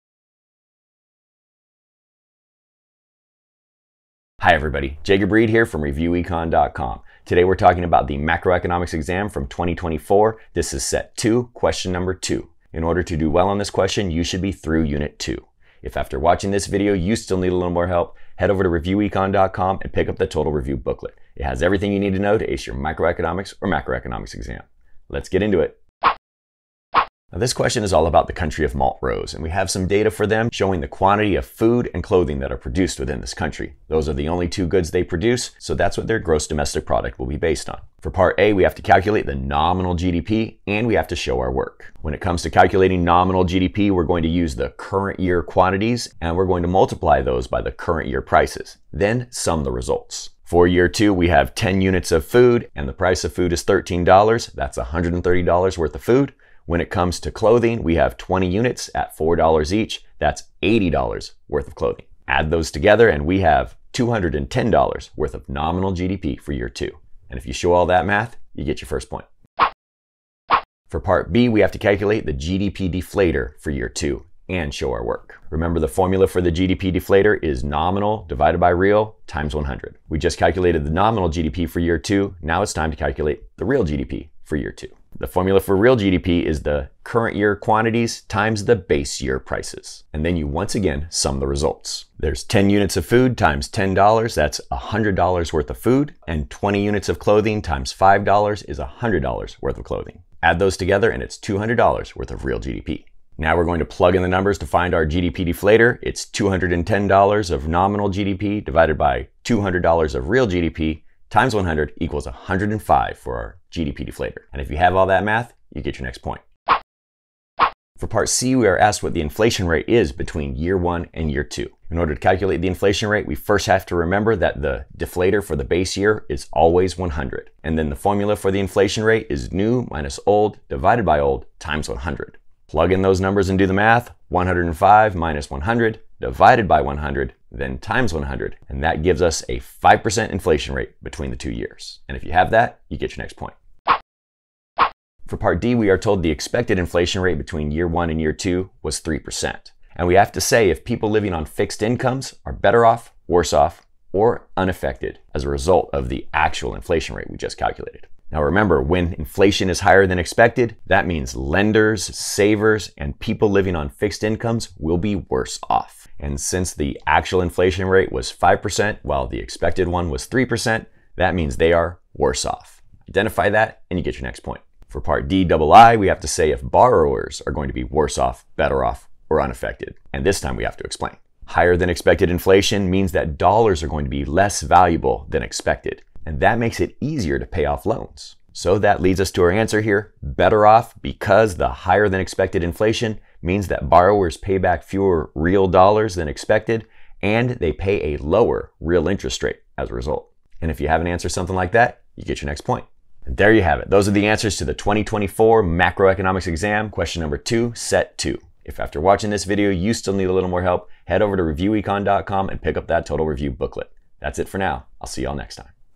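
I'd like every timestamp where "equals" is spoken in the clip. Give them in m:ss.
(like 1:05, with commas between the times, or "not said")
1:52.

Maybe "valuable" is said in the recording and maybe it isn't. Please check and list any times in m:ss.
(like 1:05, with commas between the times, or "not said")
3:04.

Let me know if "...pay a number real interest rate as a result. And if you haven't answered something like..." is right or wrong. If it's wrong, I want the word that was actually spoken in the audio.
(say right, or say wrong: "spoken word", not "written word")
wrong: "lower", not "number".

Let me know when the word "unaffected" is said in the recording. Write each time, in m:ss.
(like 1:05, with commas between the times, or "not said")
2:34, 2:59.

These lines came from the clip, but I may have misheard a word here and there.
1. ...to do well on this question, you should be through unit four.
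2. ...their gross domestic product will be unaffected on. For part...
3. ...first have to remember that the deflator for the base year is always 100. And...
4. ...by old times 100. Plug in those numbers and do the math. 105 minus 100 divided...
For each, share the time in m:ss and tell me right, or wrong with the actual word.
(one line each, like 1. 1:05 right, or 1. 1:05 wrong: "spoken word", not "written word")
1. 0:13 wrong: "two", not "four"
2. 0:36 wrong: "based", not "unaffected"
3. 2:03 right
4. 2:11 right.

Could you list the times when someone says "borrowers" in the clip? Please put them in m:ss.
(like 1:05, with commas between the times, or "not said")
2:56, 3:13.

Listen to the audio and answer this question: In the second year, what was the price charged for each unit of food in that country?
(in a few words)
$13.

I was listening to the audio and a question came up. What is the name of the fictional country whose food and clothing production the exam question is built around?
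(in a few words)
Montrose.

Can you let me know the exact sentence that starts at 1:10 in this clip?
For part B, we have to calculate the GDP deflator for year two and show our work.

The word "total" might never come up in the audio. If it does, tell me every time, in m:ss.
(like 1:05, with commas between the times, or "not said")
0:20, 3:33.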